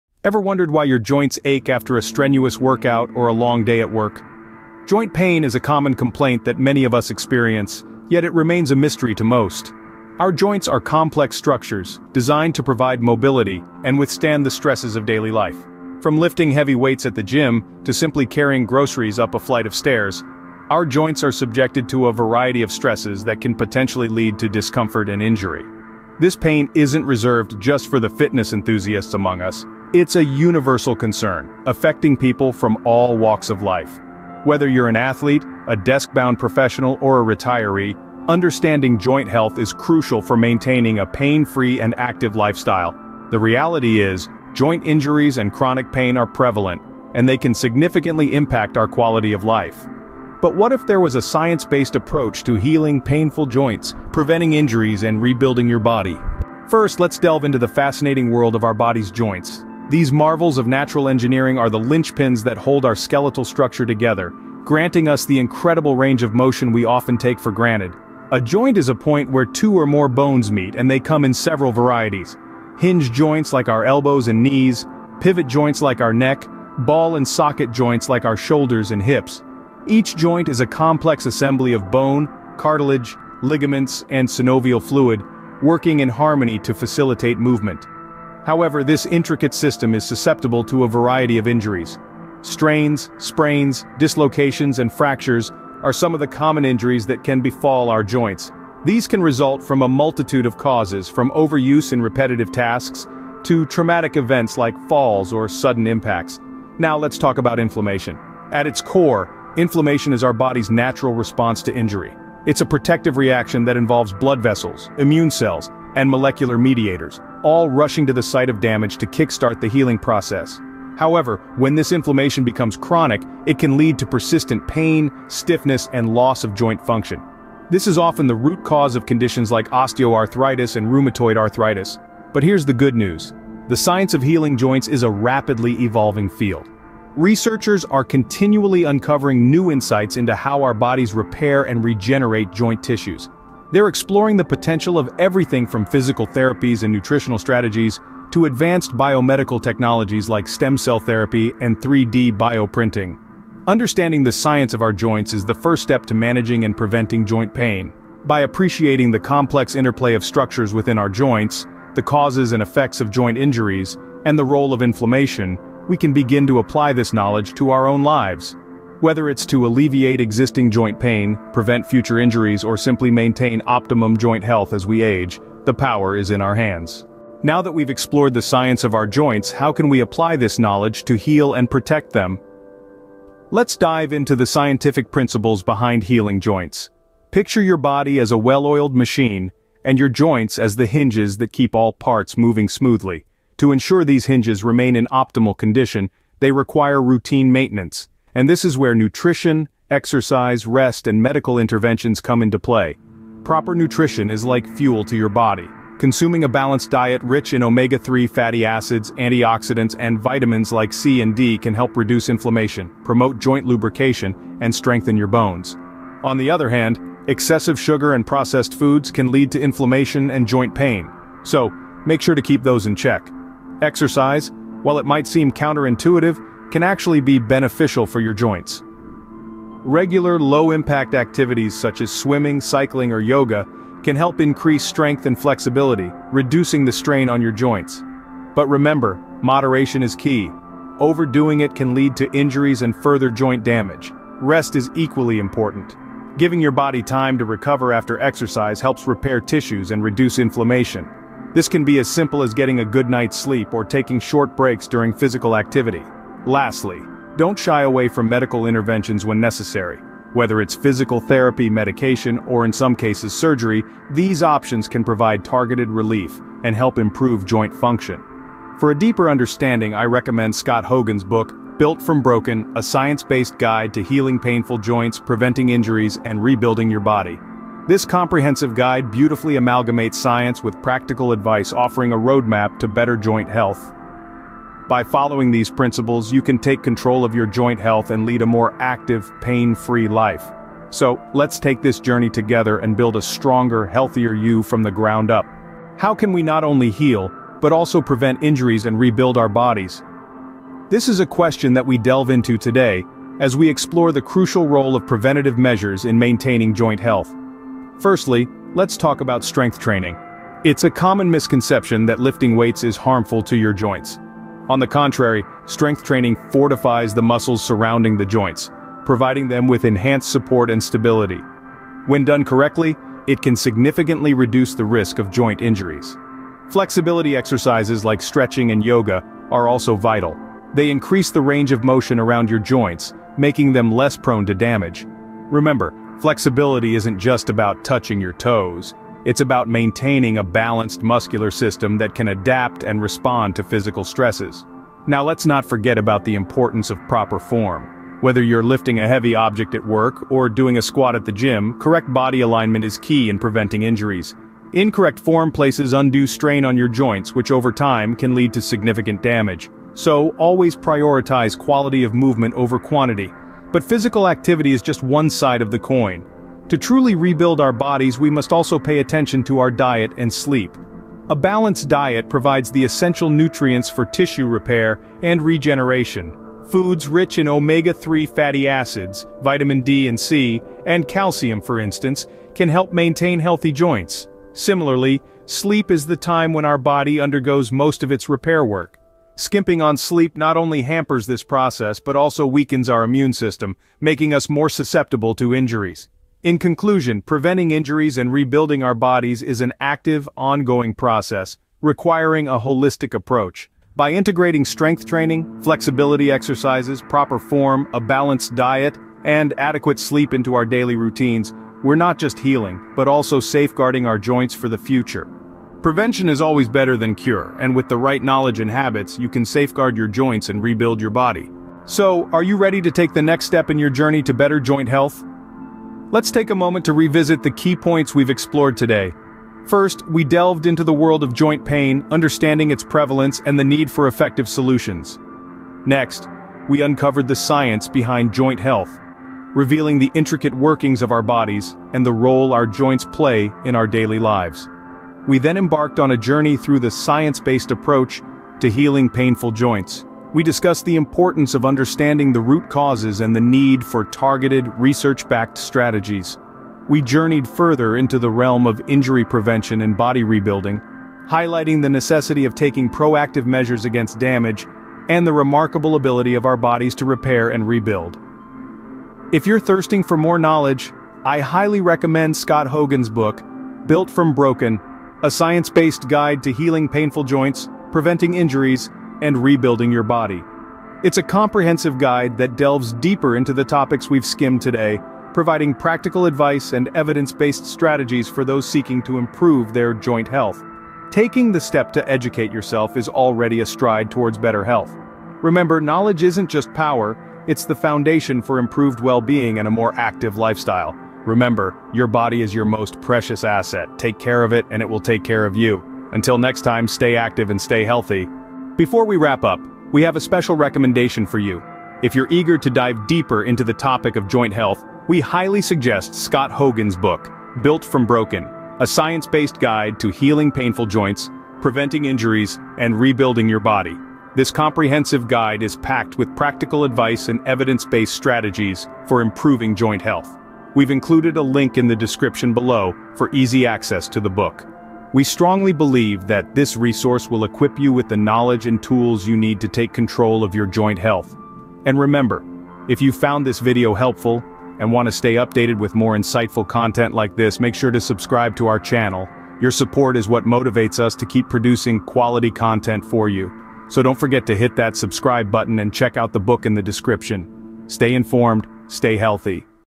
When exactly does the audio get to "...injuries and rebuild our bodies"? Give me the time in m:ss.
4:58.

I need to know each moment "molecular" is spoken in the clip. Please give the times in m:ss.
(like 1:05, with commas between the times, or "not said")
1:56.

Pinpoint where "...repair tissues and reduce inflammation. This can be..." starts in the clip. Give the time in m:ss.
4:09.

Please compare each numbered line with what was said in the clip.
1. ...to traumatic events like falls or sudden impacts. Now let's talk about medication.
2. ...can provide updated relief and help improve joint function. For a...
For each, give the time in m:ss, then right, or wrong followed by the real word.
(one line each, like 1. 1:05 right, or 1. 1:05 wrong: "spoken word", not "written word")
1. 1:43 wrong: "inflammation", not "medication"
2. 4:24 wrong: "targeted", not "updated".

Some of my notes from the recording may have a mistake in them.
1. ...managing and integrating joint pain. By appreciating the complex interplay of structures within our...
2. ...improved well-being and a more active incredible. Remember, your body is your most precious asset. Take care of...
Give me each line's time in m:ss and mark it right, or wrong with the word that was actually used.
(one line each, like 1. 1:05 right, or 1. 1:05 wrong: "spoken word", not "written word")
1. 2:36 wrong: "preventing", not "integrating"
2. 8:18 wrong: "lifestyle", not "incredible".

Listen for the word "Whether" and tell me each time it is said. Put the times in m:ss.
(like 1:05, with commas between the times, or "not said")
0:34, 2:49, 4:20, 5:48.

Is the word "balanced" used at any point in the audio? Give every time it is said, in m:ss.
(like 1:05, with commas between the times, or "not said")
3:26, 5:40, 6:11, 6:48.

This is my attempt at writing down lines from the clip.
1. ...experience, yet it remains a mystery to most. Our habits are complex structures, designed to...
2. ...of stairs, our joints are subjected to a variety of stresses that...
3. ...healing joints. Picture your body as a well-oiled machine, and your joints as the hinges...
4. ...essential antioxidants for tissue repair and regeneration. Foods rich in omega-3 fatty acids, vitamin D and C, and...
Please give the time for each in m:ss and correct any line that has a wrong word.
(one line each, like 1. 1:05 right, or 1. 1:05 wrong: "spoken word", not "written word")
1. 0:07 wrong: "joints", not "habits"
2. 0:19 right
3. 3:06 right
4. 6:12 wrong: "nutrients", not "antioxidants".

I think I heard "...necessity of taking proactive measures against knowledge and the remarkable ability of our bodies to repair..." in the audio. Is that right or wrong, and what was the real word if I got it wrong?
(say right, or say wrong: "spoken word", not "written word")
wrong: "damage", not "knowledge".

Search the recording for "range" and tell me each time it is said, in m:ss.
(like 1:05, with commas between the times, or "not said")
1:05, 5:31.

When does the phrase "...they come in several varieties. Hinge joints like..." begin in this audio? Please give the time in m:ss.
1:10.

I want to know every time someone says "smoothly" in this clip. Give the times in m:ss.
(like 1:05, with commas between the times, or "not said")
3:12.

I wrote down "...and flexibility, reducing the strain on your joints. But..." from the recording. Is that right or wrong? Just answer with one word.
right.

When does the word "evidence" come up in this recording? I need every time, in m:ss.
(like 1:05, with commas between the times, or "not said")
8:06, 8:47.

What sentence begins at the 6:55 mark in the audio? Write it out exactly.
Prevention is always better than cure, and with the right knowledge and habits, you can safeguard your joints and rebuild your body.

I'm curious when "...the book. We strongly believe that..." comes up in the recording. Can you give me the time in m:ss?
8:54.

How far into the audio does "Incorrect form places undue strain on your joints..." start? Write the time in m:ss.
5:54.